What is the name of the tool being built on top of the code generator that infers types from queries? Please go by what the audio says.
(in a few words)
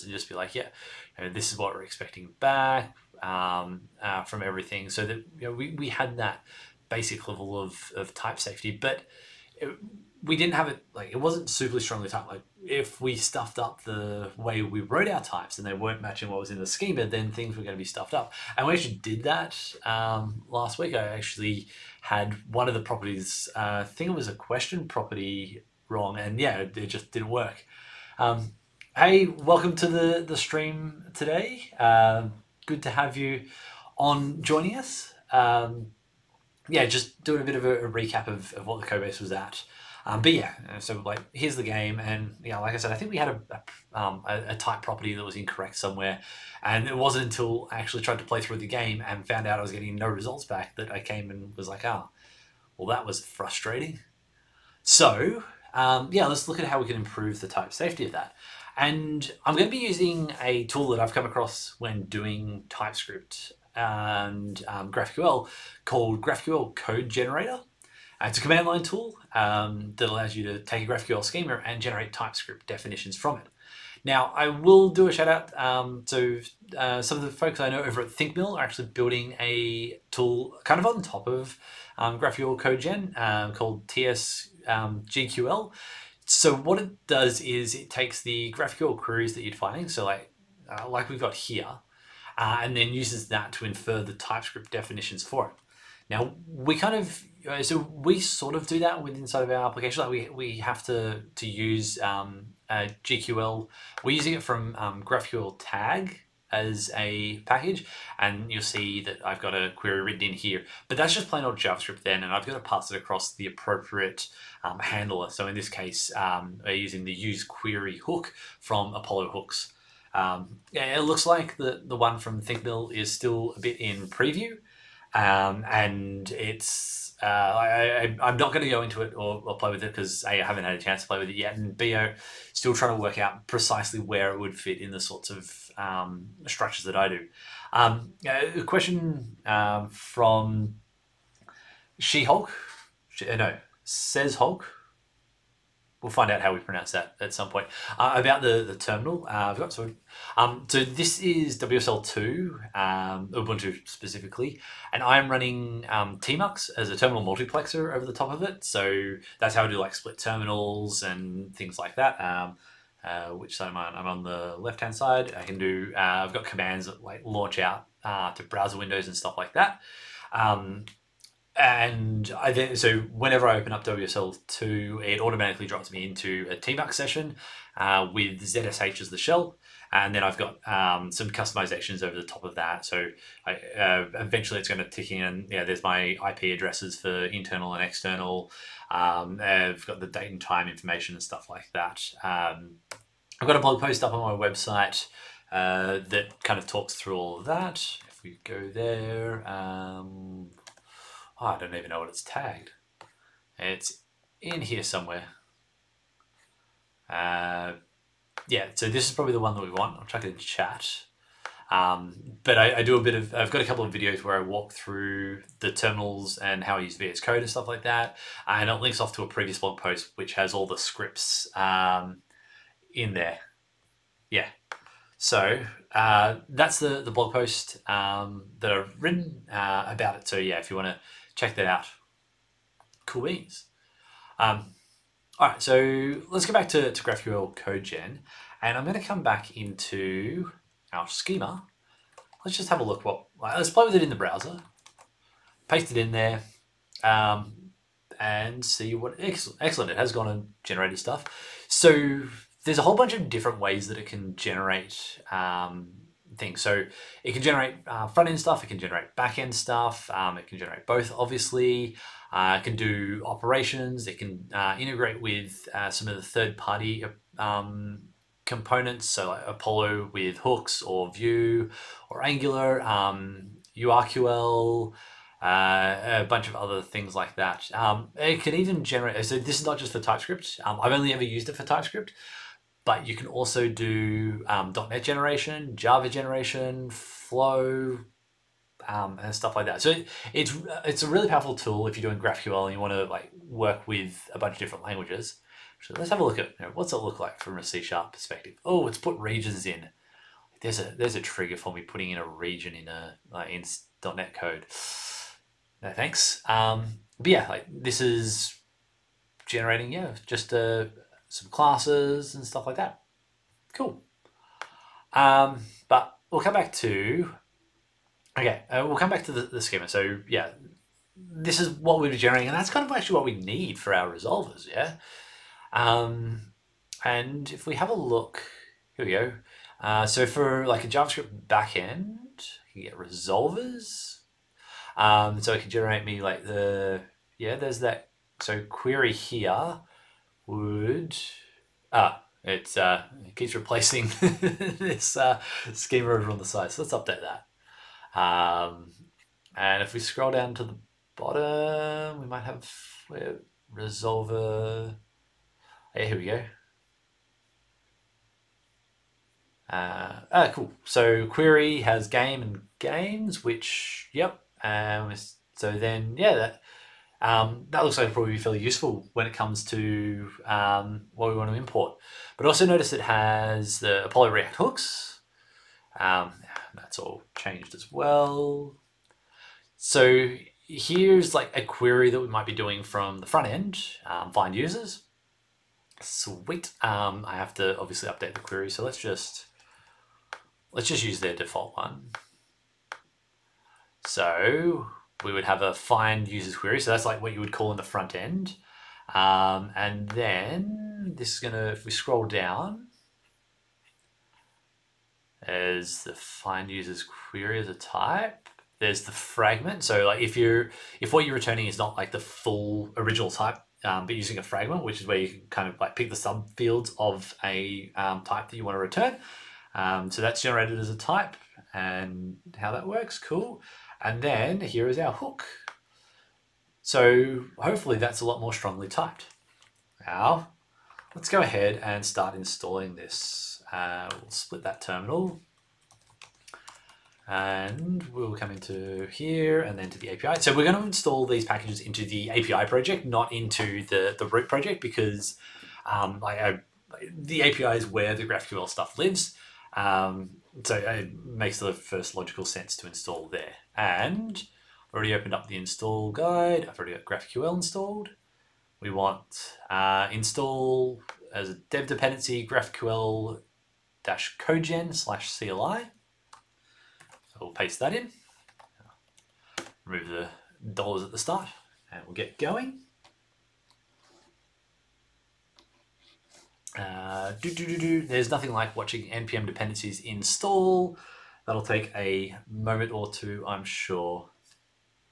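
TSGQL.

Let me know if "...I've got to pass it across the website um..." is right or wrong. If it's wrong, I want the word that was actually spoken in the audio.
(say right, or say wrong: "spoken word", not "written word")
wrong: "appropriate", not "website".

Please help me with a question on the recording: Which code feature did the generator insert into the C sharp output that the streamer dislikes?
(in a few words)
regions.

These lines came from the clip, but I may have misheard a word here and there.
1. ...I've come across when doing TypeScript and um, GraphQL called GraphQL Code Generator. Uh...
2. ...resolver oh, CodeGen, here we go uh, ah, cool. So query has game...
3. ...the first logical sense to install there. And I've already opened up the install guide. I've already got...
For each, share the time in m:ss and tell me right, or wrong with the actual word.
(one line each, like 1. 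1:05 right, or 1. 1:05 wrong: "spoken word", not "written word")
1. 1:01 right
2. 5:53 wrong: "Yeah", not "CodeGen"
3. 7:31 right.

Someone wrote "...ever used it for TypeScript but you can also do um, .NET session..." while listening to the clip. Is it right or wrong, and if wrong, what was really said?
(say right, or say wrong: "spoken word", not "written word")
wrong: "generation", not "session".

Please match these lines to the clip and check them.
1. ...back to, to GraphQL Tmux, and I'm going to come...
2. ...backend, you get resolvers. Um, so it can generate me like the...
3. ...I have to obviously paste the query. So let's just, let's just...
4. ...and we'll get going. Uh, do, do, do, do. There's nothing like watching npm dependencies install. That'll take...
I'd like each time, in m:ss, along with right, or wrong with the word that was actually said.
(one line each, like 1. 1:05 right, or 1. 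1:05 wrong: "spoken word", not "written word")
1. 3:56 wrong: "CodeGen", not "Tmux"
2. 5:31 right
3. 6:27 wrong: "update", not "paste"
4. 7:51 right.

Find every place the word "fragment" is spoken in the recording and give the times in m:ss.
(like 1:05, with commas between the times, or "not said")
6:49, 6:54.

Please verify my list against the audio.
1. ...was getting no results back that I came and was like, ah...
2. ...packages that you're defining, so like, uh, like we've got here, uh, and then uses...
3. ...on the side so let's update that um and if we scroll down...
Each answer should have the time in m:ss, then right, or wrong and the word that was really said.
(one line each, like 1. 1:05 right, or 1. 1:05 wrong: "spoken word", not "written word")
1. 0:49 right
2. 1:28 wrong: "queries", not "packages"
3. 5:46 right.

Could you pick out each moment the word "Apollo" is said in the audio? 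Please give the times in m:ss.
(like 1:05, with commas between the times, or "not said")
1:58, 4:29, 6:14.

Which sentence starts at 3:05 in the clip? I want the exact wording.
Yeah, there's my IP addresses for internal and external.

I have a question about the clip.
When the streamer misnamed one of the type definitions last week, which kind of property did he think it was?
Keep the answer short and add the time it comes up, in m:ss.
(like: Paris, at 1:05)
question property, at 0:24.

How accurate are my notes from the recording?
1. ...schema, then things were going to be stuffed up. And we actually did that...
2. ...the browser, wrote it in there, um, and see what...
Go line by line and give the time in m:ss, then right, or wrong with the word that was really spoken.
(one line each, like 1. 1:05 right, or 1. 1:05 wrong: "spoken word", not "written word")
1. 0:16 right
2. 4:04 wrong: "paste", not "wrote".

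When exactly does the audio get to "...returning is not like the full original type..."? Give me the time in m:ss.
6:51.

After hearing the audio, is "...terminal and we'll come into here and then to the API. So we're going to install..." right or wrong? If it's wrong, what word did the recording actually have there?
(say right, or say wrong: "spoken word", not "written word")
right.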